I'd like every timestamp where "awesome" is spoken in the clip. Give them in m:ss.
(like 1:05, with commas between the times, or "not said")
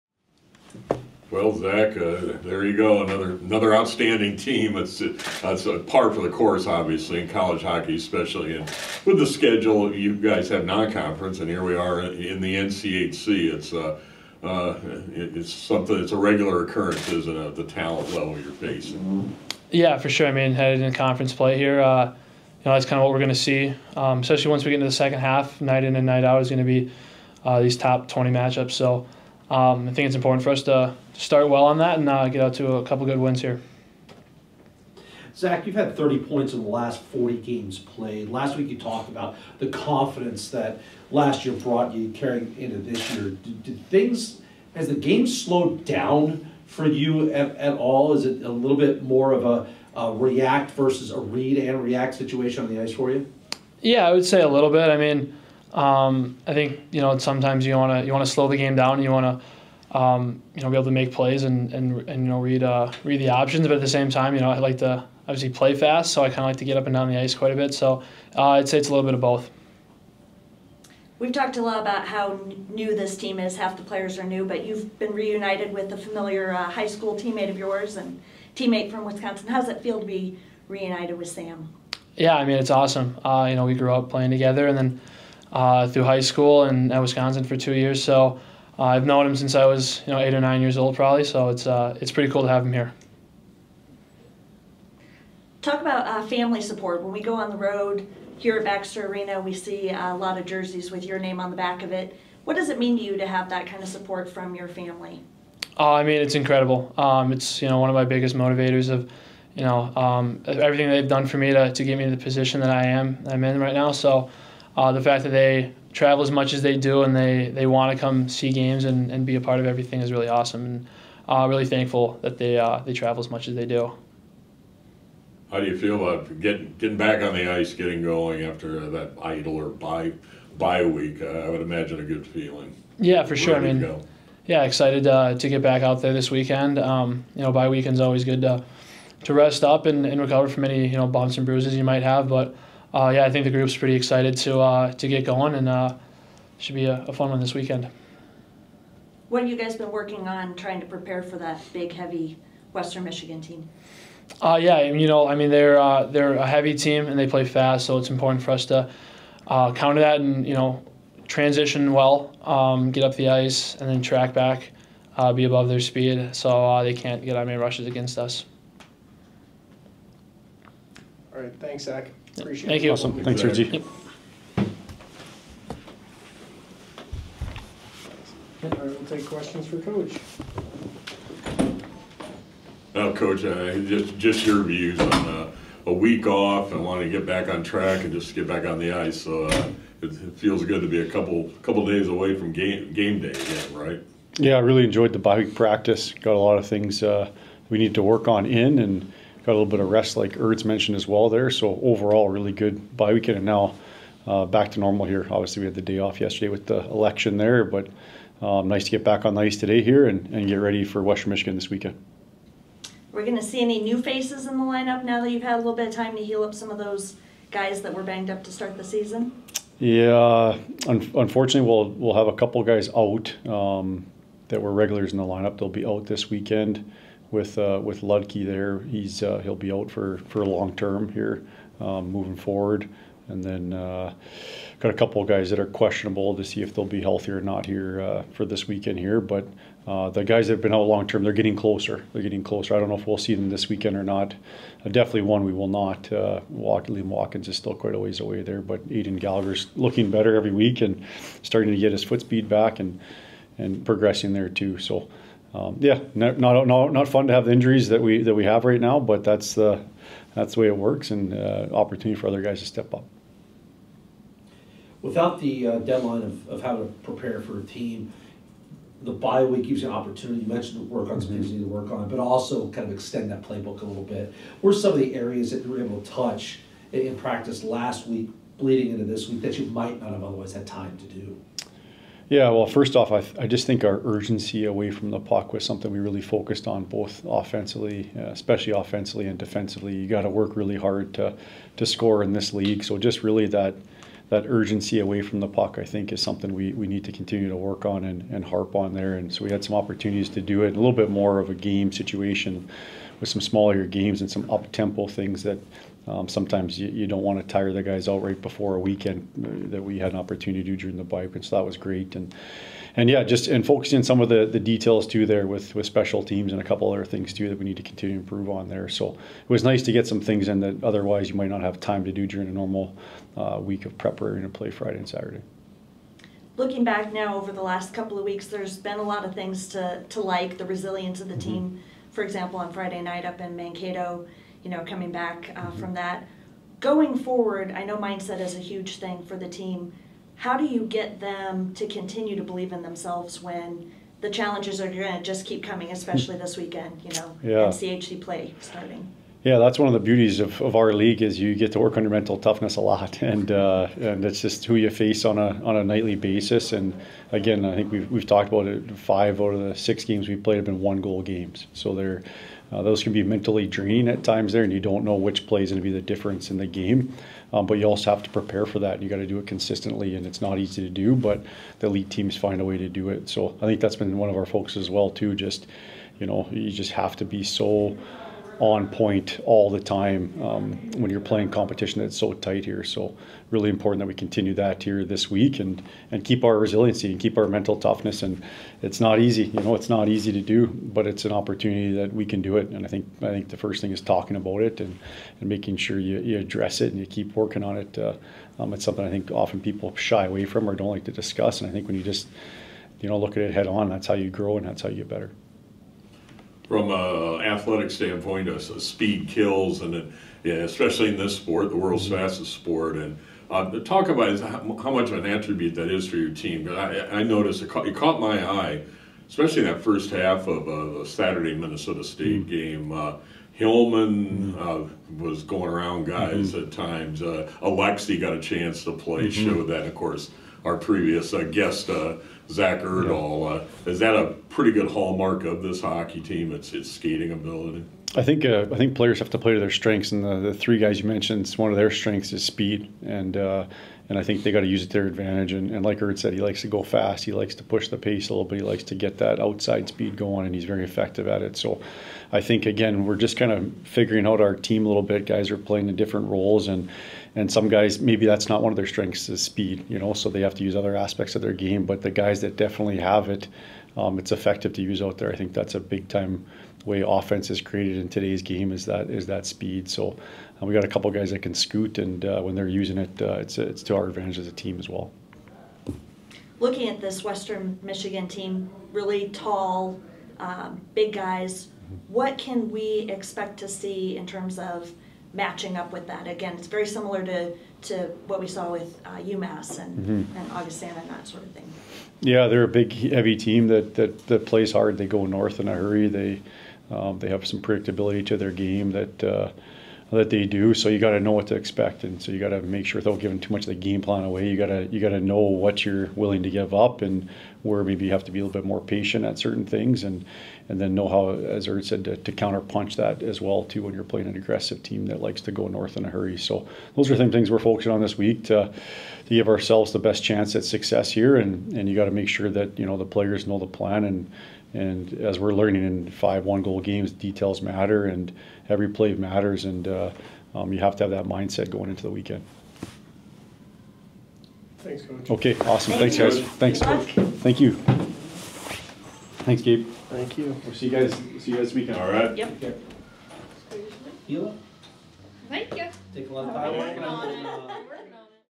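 1:22, 2:00, 2:52, 8:55.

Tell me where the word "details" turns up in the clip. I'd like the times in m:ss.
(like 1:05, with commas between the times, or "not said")
5:14, 8:47.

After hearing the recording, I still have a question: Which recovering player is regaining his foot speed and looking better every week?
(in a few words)
Aiden Gallagher.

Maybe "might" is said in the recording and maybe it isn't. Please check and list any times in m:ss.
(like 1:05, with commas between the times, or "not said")
2:21, 4:39, 5:21.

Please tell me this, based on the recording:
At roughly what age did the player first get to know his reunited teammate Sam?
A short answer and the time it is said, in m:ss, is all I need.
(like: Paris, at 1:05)
8 or 9, at 1:30.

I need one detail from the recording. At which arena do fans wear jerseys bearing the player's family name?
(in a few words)
Baxter Arena.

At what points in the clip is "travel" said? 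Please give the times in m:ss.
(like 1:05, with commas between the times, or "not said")
1:55, 2:02.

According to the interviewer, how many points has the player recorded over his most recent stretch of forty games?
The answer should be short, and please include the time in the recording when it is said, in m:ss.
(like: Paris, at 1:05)
30, at 0:35.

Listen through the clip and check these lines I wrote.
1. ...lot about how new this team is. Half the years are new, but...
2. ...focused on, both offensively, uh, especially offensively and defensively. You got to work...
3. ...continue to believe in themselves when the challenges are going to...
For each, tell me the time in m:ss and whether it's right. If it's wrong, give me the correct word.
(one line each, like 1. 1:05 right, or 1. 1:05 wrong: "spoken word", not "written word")
1. 1:11 wrong: "players", not "years"
2. 4:46 right
3. 5:41 right.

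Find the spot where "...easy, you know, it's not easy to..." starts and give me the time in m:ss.
6:29.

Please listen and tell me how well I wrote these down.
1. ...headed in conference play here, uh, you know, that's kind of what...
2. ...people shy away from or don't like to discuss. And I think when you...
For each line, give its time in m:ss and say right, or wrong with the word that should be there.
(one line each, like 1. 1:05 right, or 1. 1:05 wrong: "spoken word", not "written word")
1. 0:20 right
2. 6:39 right.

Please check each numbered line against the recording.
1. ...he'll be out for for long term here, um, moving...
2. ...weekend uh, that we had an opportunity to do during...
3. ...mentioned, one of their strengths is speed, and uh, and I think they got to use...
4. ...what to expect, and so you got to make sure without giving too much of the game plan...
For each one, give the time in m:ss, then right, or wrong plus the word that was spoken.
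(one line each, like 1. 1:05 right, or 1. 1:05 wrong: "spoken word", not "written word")
1. 3:49 right
2. 5:08 right
3. 7:21 right
4. 8:21 right.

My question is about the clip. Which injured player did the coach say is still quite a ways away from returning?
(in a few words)
Liam Watkins.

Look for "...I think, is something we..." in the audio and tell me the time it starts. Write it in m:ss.
4:55.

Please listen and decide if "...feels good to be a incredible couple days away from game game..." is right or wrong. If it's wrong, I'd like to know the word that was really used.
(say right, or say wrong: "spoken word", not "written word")
wrong: "couple", not "incredible".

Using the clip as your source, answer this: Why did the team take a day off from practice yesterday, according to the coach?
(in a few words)
The election.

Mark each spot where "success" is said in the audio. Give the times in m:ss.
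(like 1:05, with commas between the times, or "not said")
8:40.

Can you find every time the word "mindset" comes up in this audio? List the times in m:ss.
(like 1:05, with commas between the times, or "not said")
5:37, 8:51.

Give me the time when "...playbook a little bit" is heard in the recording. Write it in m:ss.
4:33.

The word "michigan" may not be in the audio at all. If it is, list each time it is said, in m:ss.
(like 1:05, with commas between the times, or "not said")
2:33, 3:31, 7:57.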